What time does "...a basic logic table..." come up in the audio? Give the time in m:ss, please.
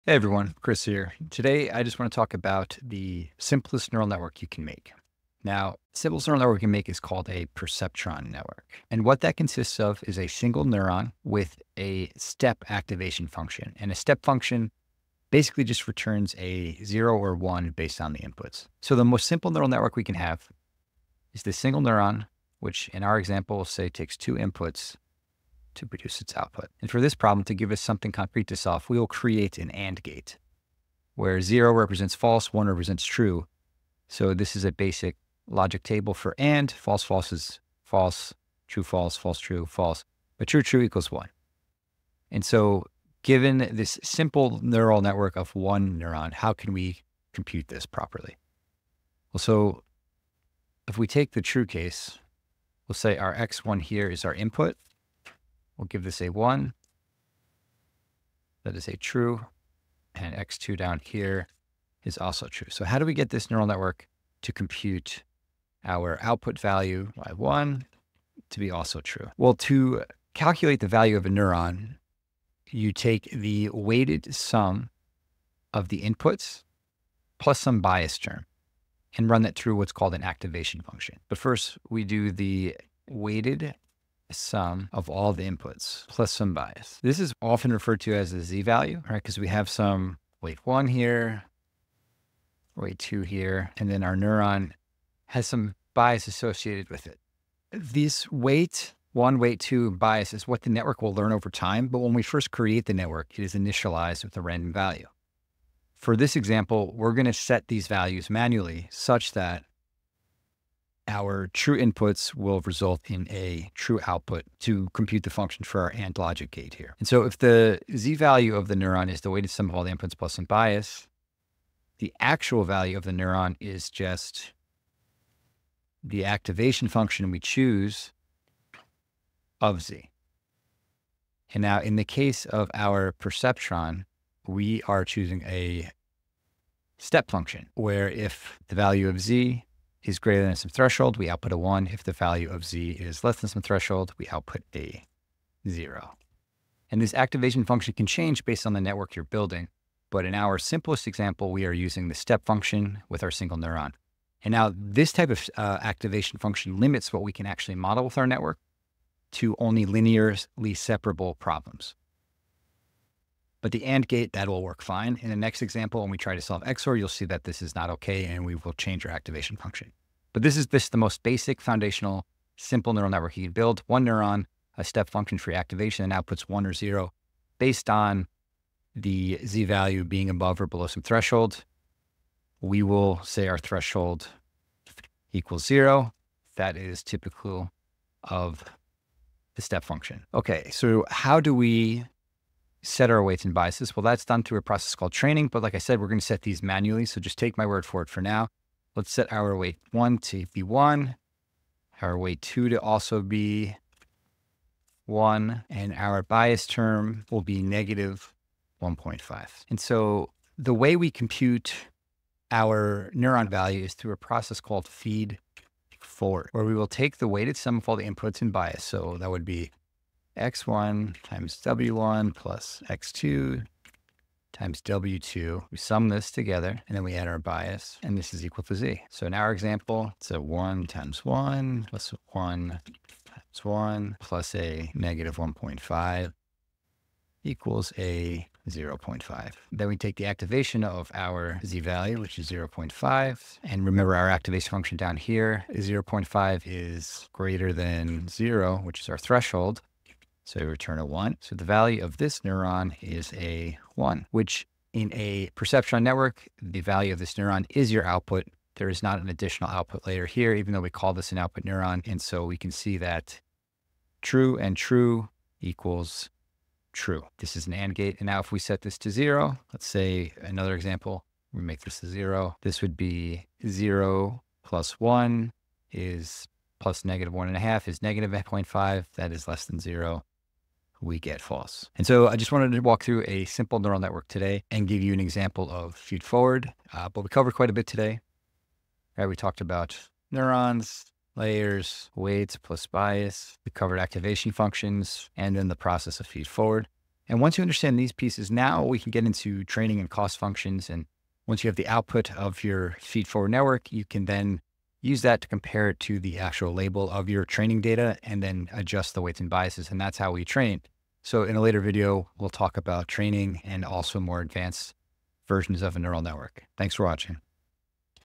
0:34.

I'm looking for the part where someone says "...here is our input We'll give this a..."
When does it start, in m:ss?
0:53.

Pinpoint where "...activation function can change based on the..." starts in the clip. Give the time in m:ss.
2:27.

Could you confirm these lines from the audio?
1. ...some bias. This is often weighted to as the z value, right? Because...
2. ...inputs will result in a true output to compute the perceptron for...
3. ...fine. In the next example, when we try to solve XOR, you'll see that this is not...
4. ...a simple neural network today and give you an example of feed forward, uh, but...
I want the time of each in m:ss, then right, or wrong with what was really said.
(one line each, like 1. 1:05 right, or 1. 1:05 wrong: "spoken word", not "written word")
1. 1:26 wrong: "referred", not "weighted"
2. 1:51 wrong: "function", not "perceptron"
3. 2:44 right
4. 4:43 right.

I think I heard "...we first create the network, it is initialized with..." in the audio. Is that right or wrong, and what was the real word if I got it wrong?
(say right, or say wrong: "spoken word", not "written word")
right.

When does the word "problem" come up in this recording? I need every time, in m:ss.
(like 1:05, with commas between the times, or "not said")
0:27, 2:41.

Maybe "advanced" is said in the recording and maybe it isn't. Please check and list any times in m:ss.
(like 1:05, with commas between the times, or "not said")
5:14.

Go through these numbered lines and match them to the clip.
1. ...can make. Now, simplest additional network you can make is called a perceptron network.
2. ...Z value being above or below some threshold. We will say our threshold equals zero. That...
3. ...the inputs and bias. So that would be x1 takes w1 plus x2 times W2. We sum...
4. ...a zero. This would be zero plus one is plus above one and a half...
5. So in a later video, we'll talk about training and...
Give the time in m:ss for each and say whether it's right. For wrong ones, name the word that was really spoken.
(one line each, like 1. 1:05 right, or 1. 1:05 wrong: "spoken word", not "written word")
1. 0:04 wrong: "neural", not "additional"
2. 2:59 right
3. 3:37 wrong: "times", not "takes"
4. 4:32 wrong: "negative", not "above"
5. 5:11 right.